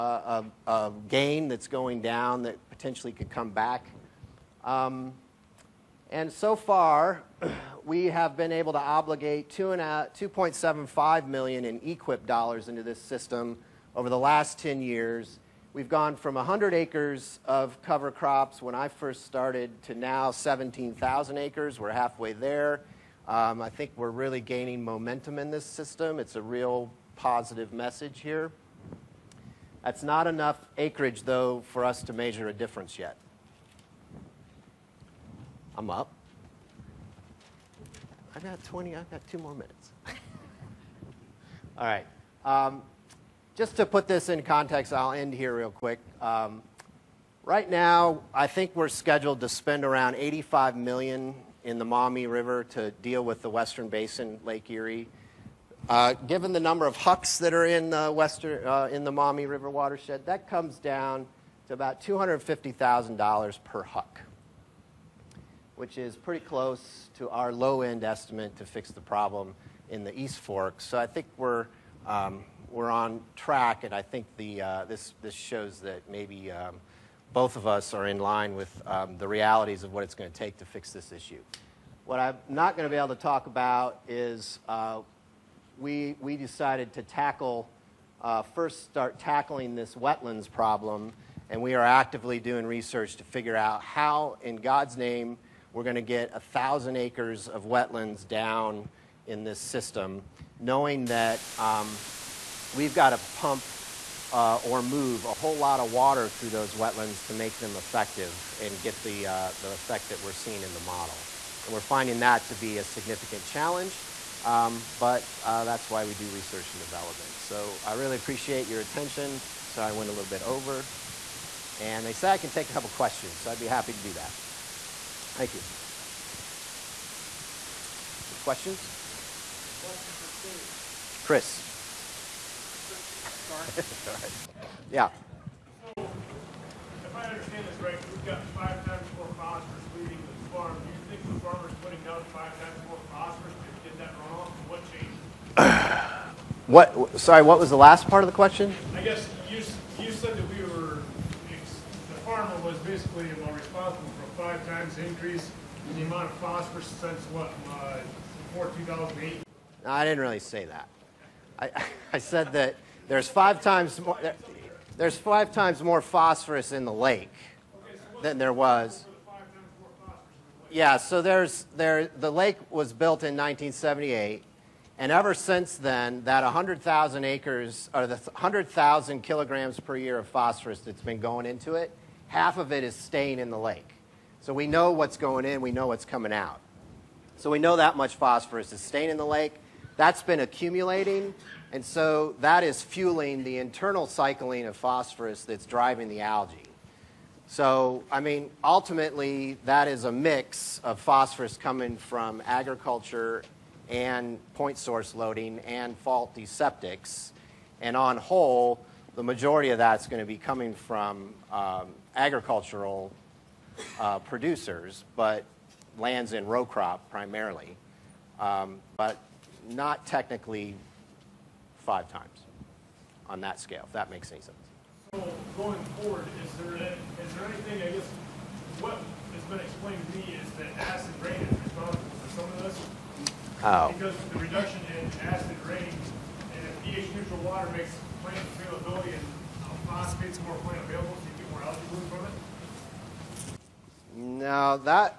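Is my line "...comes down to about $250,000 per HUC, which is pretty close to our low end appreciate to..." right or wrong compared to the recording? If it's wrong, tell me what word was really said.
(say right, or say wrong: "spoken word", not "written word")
wrong: "estimate", not "appreciate".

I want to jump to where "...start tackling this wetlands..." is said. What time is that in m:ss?
1:28.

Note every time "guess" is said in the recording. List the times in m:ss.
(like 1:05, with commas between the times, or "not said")
2:29, 3:47.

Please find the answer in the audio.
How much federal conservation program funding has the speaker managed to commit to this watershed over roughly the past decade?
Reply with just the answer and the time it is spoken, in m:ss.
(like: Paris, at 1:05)
$2.75 million, at 0:10.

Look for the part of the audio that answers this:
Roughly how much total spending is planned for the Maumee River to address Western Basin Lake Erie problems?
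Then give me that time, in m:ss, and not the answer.
0:50.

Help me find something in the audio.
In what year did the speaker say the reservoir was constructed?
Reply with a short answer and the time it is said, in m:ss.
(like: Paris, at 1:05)
1978, at 2:53.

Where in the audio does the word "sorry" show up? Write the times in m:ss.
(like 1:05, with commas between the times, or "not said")
1:59, 2:13, 2:27.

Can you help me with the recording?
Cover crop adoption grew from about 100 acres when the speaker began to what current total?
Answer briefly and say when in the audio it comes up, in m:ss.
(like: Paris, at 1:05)
17,000 acres, at 0:20.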